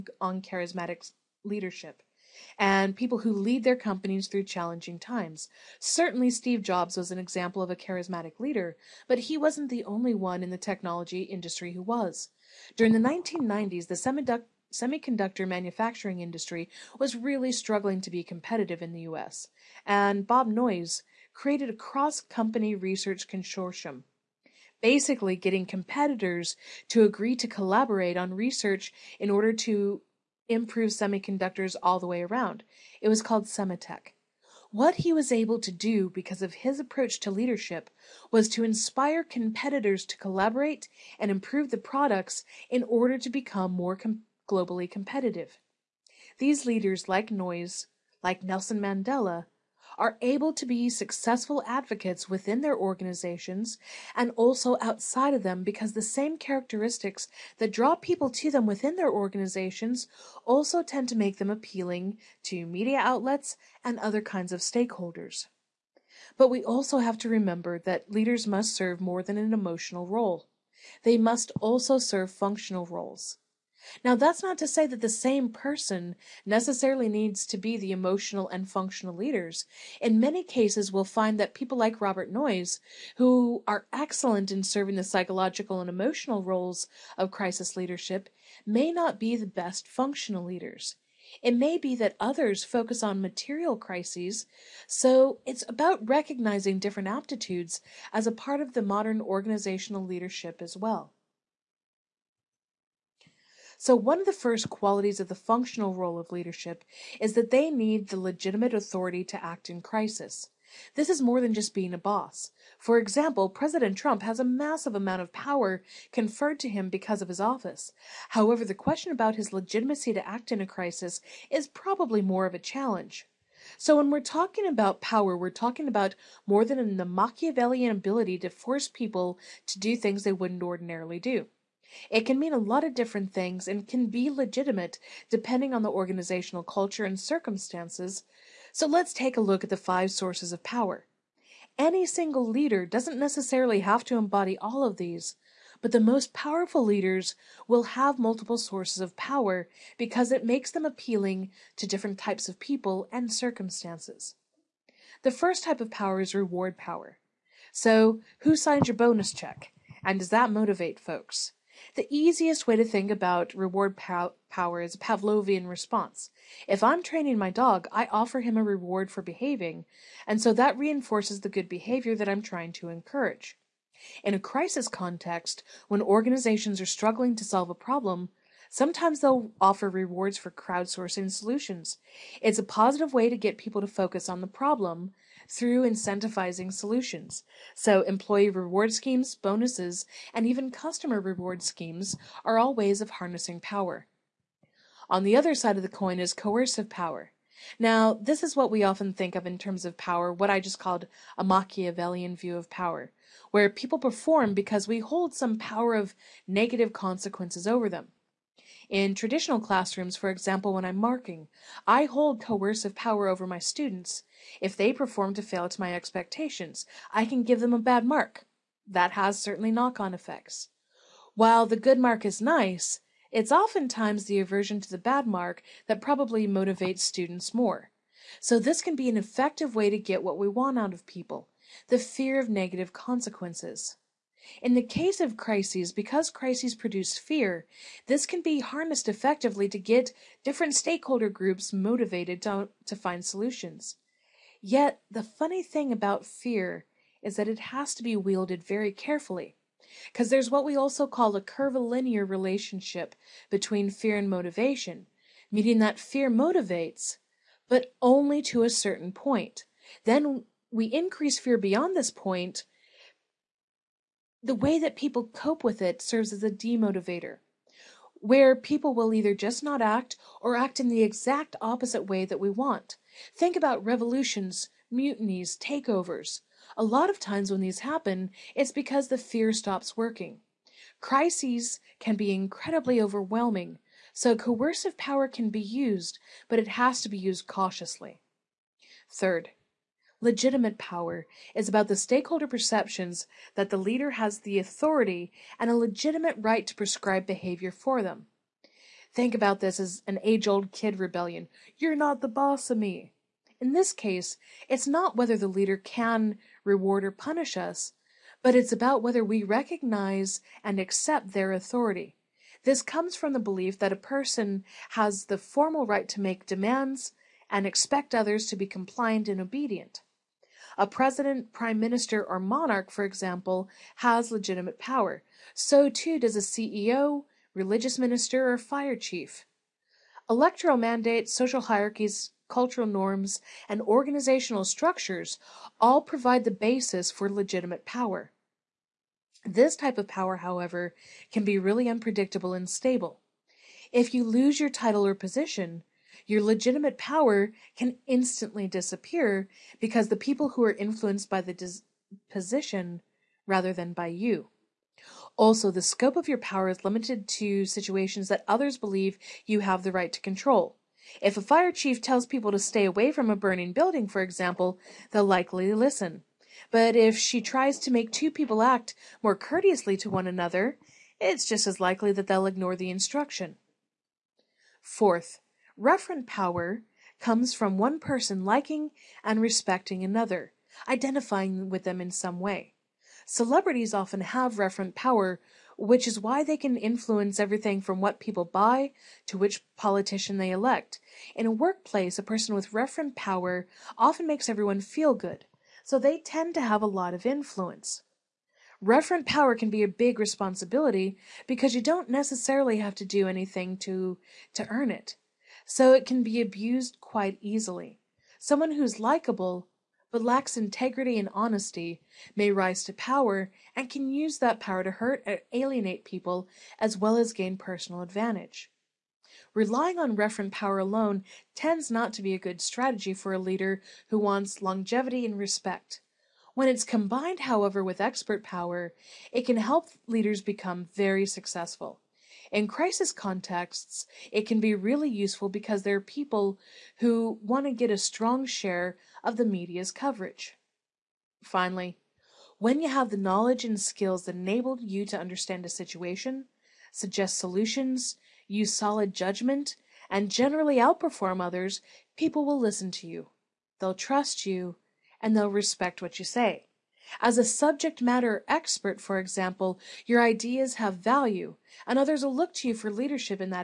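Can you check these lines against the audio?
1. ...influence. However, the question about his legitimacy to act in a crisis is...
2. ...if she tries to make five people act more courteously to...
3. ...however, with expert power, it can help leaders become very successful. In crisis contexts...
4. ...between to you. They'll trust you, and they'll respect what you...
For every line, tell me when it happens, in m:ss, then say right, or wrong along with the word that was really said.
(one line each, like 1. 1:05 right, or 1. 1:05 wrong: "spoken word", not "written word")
1. 1:57 wrong: "office", not "influence"
2. 6:06 wrong: "two", not "five"
3. 7:07 right
4. 7:32 wrong: "listen", not "between".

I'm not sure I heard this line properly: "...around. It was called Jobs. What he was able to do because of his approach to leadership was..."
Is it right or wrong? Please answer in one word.
wrong.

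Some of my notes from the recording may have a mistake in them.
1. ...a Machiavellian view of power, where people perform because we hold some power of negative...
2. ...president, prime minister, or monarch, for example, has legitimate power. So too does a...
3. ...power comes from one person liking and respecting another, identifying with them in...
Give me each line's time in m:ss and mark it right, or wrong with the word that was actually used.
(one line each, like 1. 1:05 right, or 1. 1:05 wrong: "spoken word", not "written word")
1. 3:21 right
2. 5:20 right
3. 6:16 right.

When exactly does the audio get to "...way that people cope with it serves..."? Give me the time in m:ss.
4:24.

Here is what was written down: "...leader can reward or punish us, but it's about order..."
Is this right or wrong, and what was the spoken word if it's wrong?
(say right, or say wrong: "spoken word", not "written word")
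wrong: "whether", not "order".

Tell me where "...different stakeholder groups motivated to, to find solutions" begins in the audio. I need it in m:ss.
4:00.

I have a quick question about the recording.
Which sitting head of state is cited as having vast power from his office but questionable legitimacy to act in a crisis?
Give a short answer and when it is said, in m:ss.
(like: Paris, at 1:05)
President Trump, at 1:53.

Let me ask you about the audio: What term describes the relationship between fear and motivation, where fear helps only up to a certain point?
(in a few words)
Curvilinear.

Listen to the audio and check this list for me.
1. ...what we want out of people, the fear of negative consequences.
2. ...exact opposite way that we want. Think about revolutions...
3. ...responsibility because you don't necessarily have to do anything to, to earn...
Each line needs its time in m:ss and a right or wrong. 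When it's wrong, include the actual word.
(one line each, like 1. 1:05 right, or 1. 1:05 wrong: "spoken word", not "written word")
1. 3:50 right
2. 4:31 right
3. 6:40 right.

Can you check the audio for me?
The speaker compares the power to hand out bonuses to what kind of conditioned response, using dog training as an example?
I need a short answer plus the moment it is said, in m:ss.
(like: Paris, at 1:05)
Pavlovian response, at 2:44.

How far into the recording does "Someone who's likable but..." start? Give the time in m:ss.
6:48.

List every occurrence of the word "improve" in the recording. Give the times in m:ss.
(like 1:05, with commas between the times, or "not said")
0:30, 0:41.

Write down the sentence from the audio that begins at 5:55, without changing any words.
Also, the scope of your power is limited to situations that others believe you have the right to control.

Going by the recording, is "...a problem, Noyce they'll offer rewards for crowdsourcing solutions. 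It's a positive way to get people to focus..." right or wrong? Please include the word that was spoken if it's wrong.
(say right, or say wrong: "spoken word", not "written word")
wrong: "Sometimes", not "Noyce".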